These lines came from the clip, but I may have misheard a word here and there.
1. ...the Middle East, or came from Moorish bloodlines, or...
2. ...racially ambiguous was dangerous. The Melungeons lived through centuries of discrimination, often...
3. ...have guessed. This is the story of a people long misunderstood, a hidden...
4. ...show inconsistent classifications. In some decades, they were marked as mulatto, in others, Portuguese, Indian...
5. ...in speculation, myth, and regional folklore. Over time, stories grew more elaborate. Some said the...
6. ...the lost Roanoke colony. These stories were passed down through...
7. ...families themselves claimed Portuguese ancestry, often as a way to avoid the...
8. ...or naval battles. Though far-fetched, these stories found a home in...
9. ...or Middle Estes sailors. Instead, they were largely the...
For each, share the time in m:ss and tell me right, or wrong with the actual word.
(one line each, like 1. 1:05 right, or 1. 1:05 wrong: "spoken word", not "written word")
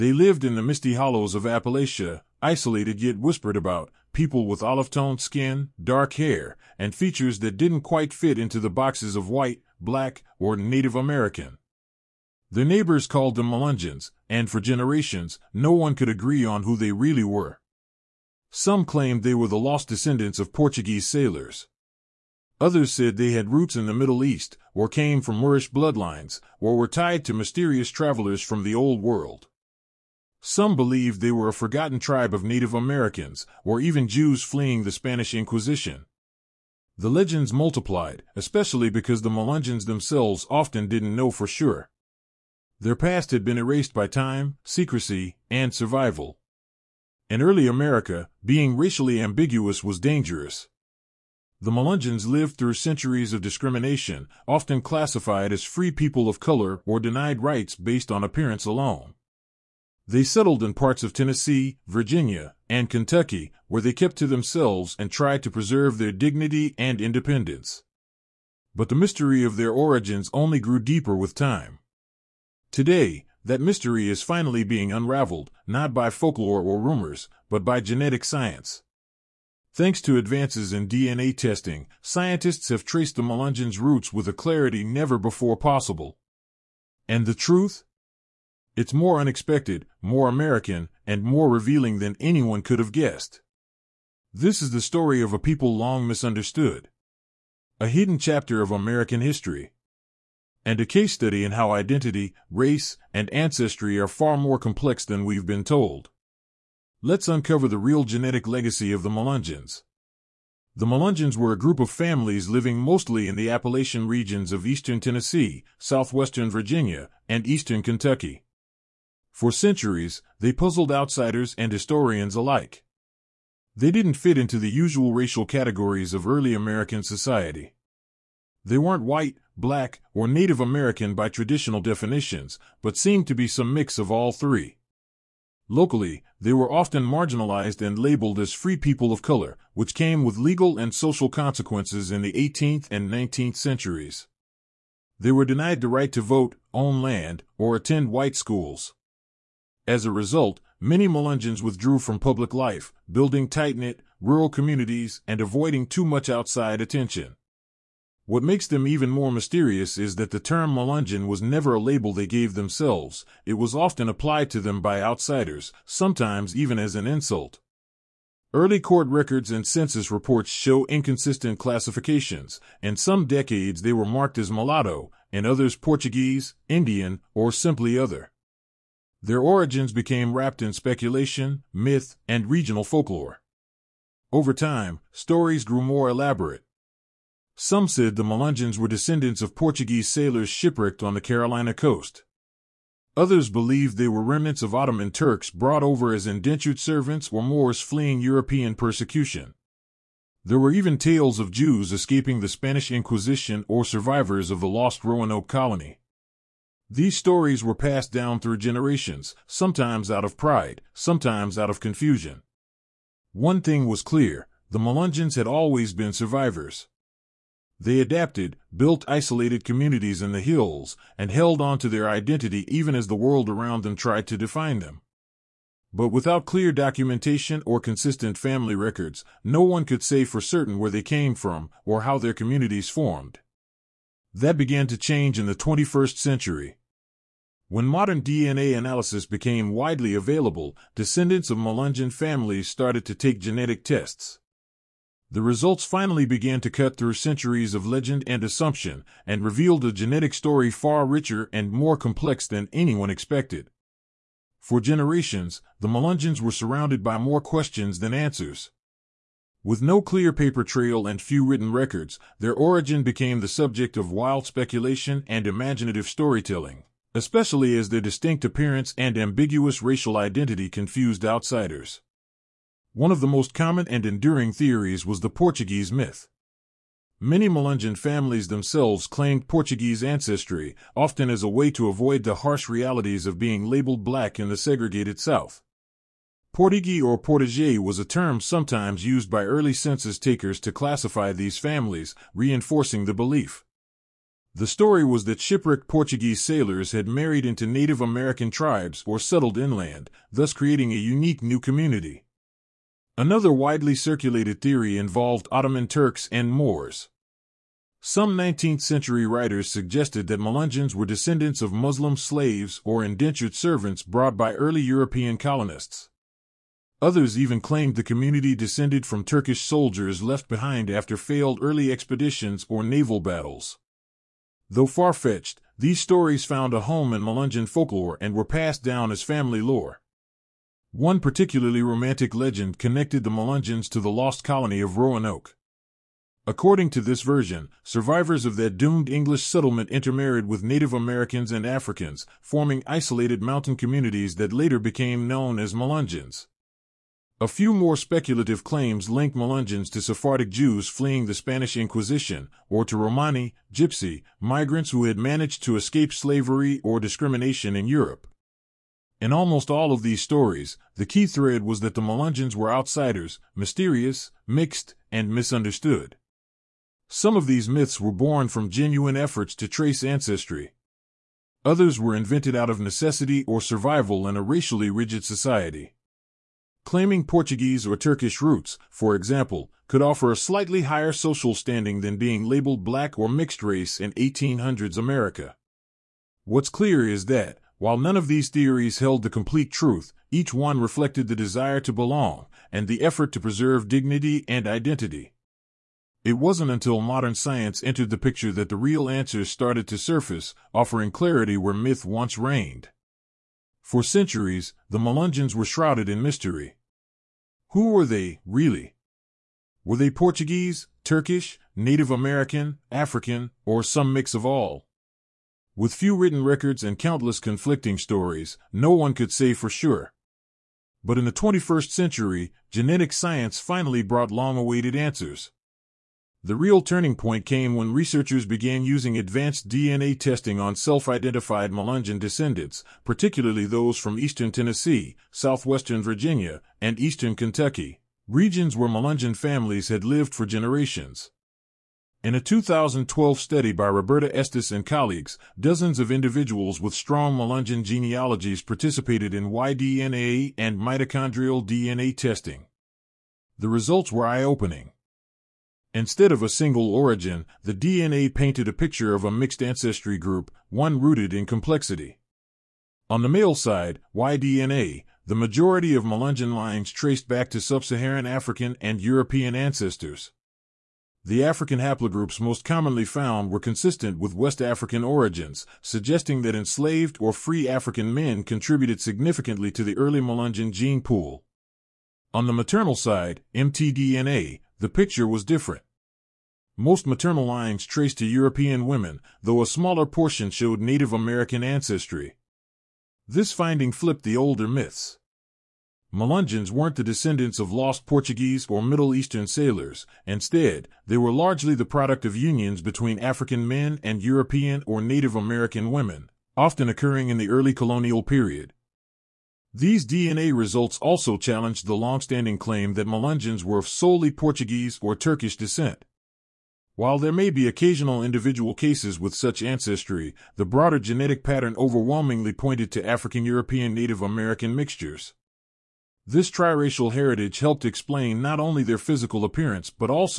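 1. 0:23 right
2. 0:48 right
3. 1:32 right
4. 2:50 right
5. 3:00 right
6. 3:24 right
7. 4:37 right
8. 5:22 right
9. 8:18 wrong: "Eastern", not "Estes".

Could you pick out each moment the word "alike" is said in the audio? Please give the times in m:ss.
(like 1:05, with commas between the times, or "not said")
2:02.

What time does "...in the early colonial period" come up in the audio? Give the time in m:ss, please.
8:27.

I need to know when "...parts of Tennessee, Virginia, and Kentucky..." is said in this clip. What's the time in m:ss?
1:00.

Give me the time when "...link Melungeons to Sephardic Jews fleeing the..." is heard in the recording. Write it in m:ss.
5:49.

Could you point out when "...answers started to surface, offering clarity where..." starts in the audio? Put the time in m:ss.
6:39.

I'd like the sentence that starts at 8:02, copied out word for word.
On the maternal side, mtDNA, the picture was different.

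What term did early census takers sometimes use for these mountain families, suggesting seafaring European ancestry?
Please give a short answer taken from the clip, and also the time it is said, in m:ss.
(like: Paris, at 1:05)
Portigi, at 4:46.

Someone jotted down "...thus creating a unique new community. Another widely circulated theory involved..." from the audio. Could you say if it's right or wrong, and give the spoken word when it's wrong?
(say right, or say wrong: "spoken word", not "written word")
right.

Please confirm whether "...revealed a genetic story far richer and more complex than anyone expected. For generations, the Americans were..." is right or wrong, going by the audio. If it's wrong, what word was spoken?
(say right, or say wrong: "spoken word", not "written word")
wrong: "Melungeons", not "Americans".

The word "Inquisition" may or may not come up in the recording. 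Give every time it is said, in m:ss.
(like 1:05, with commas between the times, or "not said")
0:35, 3:22, 5:51.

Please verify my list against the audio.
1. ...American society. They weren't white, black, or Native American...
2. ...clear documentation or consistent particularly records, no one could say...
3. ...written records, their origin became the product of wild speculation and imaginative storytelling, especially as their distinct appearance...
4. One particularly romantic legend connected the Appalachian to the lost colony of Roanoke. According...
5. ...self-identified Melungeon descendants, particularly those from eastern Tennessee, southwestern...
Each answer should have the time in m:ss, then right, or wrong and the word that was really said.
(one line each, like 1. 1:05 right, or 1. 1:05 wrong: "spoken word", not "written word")
1. 2:06 right
2. 3:46 wrong: "family", not "particularly"
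3. 4:21 wrong: "subject", not "product"
4. 5:30 wrong: "Melungeons", not "Appalachian"
5. 7:10 right.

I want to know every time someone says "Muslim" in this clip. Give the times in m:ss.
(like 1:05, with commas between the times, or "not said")
5:11.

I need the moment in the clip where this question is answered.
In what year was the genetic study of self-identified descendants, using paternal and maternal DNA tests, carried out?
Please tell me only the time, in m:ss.
7:22.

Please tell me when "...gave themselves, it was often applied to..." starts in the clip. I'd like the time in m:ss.
2:42.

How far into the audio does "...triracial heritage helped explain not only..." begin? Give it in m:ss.
8:46.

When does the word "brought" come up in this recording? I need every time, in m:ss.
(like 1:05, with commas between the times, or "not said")
3:15, 5:14, 7:04.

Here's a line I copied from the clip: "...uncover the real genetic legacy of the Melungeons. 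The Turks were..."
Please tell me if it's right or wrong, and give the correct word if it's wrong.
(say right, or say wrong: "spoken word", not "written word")
wrong: "Melungeons", not "Turks".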